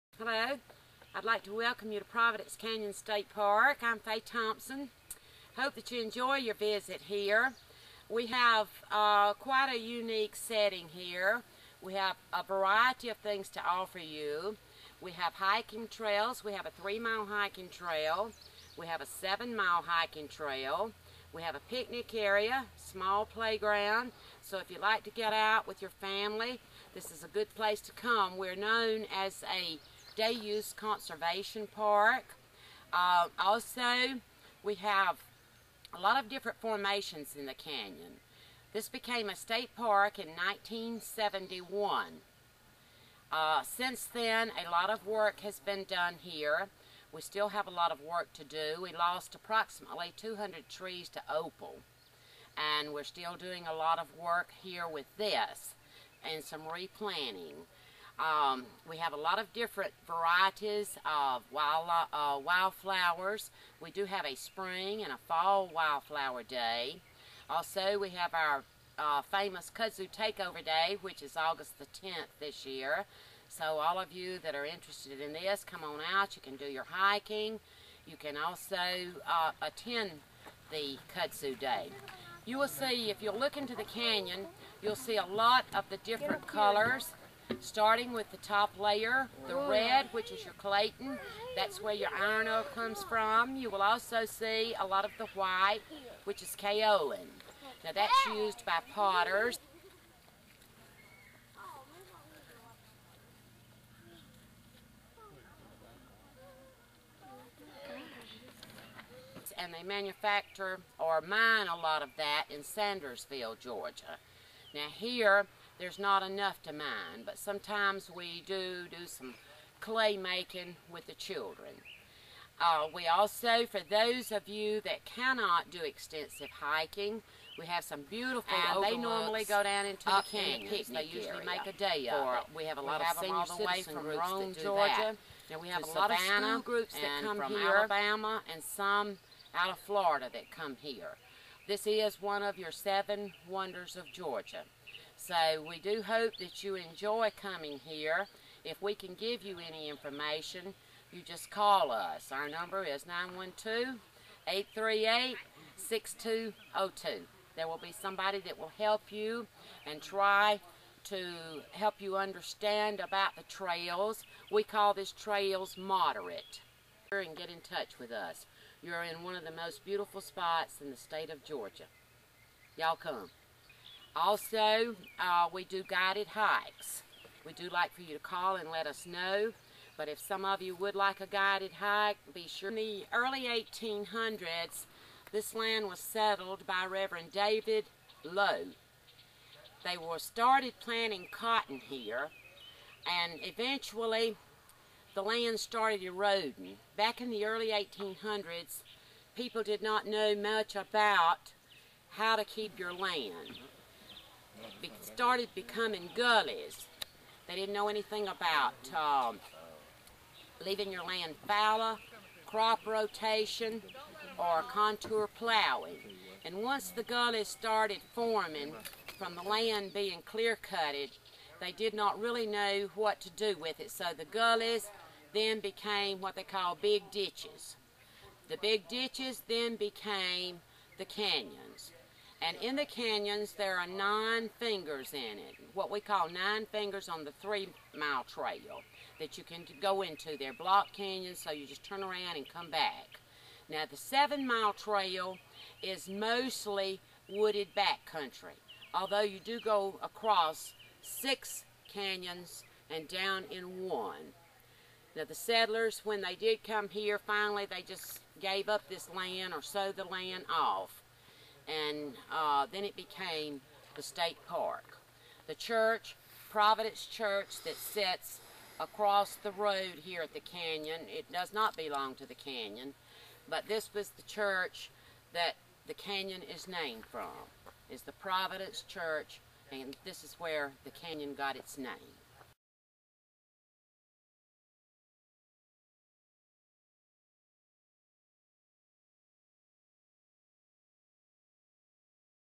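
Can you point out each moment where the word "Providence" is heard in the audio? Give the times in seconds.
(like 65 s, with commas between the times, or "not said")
2 s, 266 s, 278 s.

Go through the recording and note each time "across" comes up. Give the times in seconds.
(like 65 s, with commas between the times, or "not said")
250 s, 268 s.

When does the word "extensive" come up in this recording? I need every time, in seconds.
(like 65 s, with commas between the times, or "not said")
125 s.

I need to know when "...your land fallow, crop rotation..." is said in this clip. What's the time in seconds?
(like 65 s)
210 s.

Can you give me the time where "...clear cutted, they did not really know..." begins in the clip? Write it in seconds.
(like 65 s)
220 s.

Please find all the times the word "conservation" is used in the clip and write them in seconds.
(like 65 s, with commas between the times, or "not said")
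30 s.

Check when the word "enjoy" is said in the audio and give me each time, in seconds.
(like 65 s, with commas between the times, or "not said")
6 s, 146 s.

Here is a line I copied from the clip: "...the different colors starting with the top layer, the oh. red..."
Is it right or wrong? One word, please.
right.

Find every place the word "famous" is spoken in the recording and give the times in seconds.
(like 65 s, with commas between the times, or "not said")
69 s.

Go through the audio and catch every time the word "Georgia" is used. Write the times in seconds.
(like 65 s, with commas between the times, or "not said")
113 s, 134 s, 144 s, 171 s.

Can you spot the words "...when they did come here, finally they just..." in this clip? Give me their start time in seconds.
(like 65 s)
256 s.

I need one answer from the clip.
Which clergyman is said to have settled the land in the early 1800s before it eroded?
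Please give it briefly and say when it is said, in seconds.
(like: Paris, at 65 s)
Reverend David Lowe, at 186 s.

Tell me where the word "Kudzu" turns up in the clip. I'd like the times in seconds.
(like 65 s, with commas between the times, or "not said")
69 s, 81 s.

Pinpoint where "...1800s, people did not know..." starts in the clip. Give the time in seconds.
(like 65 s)
197 s.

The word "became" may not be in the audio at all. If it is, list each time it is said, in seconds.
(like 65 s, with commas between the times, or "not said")
38 s, 225 s, 229 s, 262 s.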